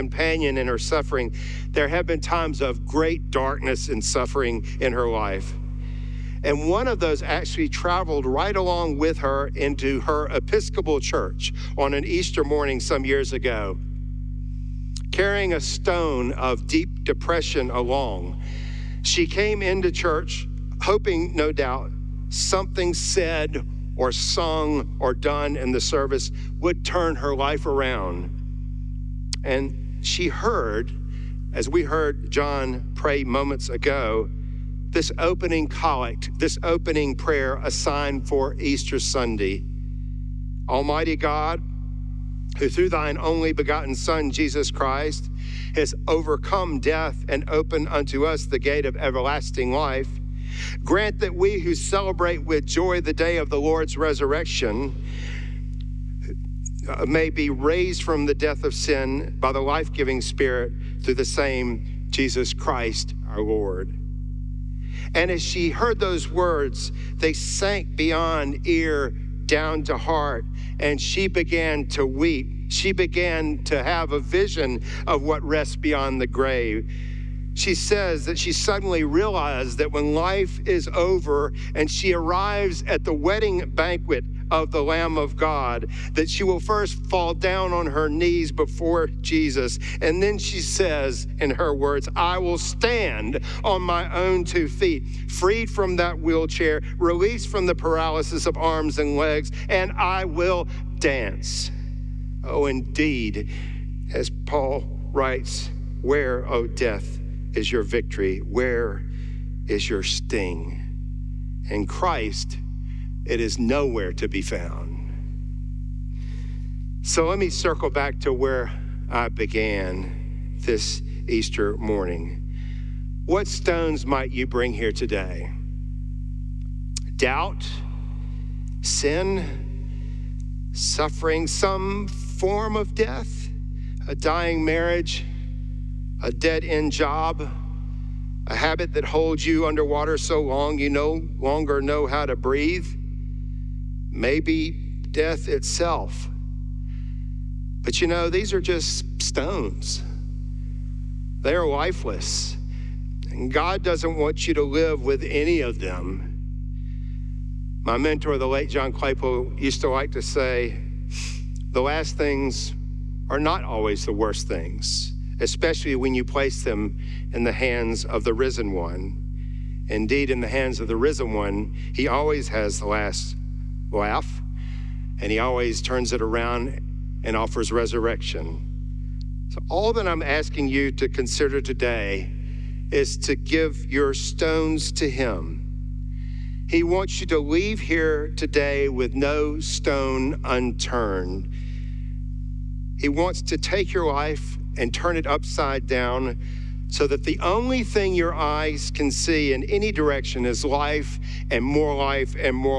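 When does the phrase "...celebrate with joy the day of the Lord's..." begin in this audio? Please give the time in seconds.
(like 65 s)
51 s.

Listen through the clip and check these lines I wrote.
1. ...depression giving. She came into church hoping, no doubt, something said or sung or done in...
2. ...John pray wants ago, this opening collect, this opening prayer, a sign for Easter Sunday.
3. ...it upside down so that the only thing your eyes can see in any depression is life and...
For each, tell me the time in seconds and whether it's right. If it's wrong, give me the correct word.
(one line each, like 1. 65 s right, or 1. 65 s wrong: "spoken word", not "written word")
1. 17 s wrong: "along", not "giving"
2. 32 s wrong: "moments", not "wants"
3. 195 s wrong: "direction", not "depression".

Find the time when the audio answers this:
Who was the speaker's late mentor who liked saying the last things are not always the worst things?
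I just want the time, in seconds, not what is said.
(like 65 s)
158 s.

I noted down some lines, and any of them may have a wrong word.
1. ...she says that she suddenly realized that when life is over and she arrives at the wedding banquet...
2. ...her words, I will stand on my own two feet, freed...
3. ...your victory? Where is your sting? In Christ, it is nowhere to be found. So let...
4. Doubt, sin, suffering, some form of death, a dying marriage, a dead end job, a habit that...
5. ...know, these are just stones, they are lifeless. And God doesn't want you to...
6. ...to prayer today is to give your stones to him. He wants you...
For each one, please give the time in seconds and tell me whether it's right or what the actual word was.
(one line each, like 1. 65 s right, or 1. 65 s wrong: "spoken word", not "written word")
1. 77 s right
2. 91 s right
3. 107 s right
4. 127 s right
5. 148 s right
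6. 180 s wrong: "consider", not "prayer".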